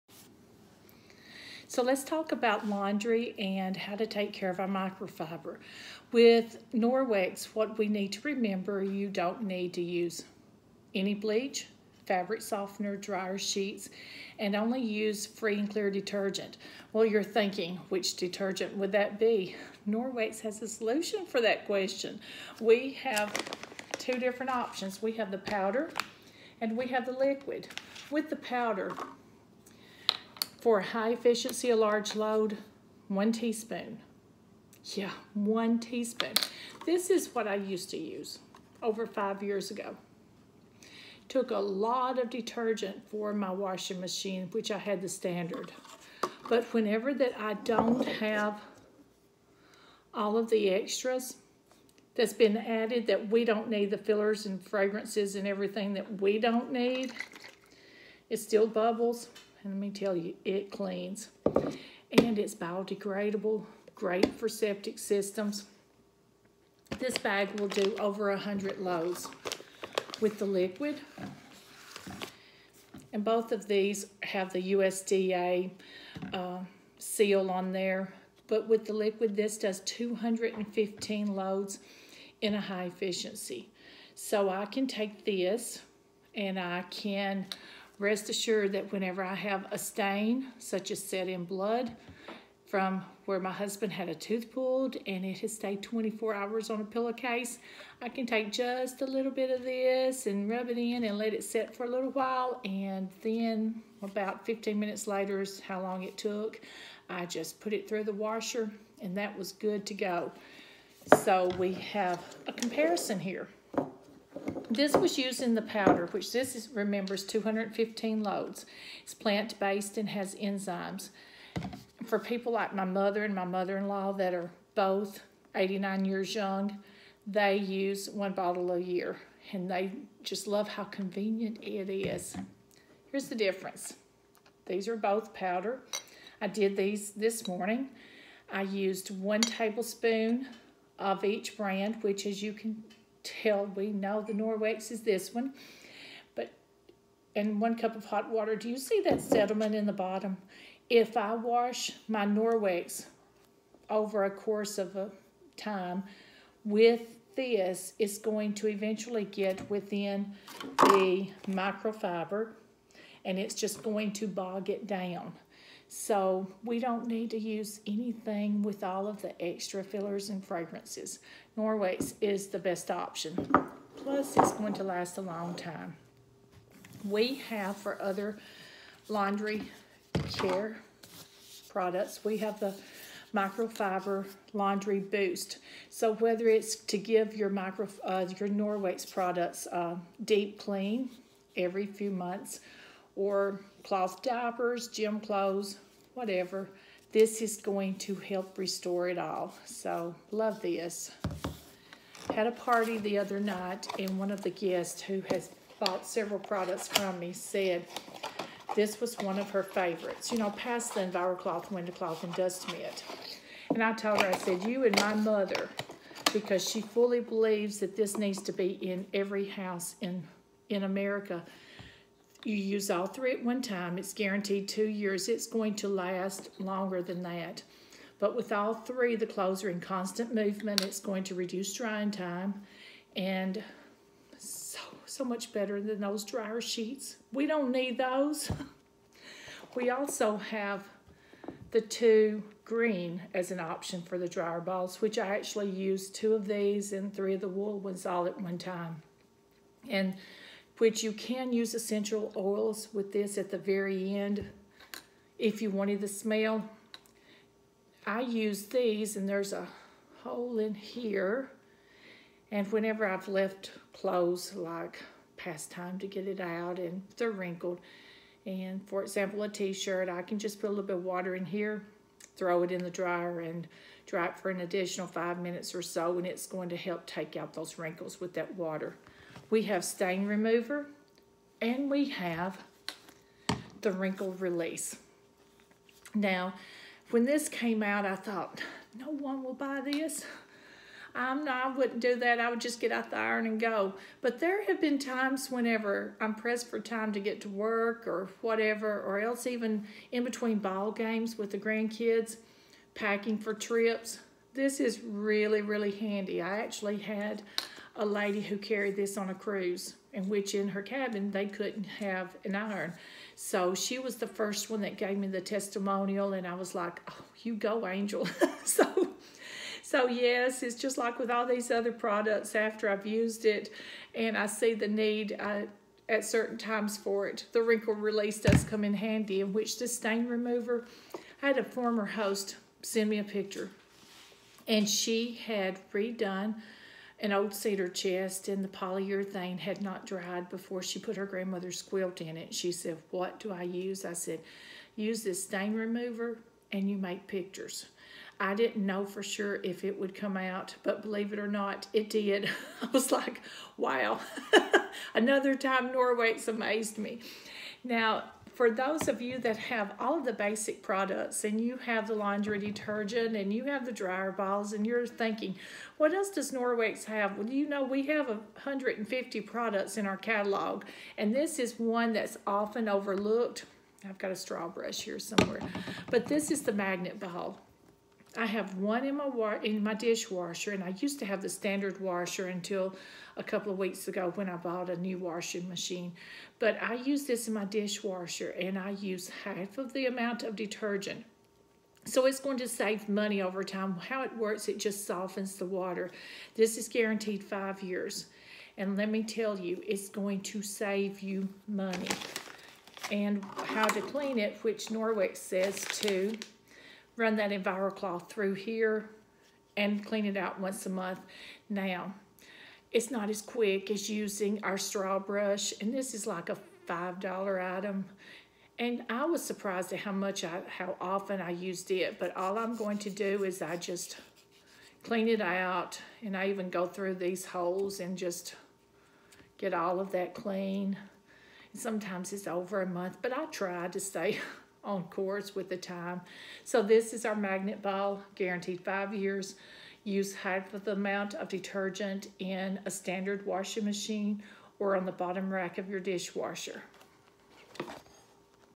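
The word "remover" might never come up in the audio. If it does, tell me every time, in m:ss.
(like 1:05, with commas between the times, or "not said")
4:40, 5:30, 5:45.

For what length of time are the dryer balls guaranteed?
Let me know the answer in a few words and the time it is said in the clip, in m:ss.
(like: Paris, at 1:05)
2 years, at 3:44.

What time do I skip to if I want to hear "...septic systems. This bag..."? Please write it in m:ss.
1:04.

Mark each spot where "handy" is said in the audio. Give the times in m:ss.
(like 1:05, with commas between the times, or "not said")
5:05, 5:28.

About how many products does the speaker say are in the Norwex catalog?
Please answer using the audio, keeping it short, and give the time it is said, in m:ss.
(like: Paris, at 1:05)
150, at 6:08.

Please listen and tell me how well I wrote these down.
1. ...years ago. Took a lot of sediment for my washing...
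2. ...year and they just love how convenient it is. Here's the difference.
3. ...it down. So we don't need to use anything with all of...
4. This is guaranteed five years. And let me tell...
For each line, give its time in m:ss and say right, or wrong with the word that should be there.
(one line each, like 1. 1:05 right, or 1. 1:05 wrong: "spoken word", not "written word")
1. 0:39 wrong: "detergent", not "sediment"
2. 2:08 right
3. 2:44 right
4. 6:36 right.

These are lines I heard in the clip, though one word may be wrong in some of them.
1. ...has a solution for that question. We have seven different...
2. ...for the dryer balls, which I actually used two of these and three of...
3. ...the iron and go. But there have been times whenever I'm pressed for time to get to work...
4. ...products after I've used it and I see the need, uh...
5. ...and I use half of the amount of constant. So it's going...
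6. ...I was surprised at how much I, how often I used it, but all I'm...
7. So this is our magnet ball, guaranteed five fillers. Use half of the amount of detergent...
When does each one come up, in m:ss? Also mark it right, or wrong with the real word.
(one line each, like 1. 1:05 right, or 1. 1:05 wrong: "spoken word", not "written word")
1. 0:20 wrong: "two", not "seven"
2. 4:04 right
3. 4:53 right
4. 5:21 right
5. 6:28 wrong: "detergent", not "constant"
6. 6:59 right
7. 7:16 wrong: "years", not "fillers".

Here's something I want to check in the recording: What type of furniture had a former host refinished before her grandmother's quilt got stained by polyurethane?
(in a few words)
cedar chest.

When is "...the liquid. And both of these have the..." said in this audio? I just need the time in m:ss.
1:10.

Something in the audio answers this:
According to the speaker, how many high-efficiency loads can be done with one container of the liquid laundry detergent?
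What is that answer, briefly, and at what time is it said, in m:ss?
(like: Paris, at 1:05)
215, at 1:19.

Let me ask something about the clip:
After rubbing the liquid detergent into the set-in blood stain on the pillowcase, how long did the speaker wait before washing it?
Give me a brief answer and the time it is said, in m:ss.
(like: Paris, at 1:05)
15 minutes, at 1:44.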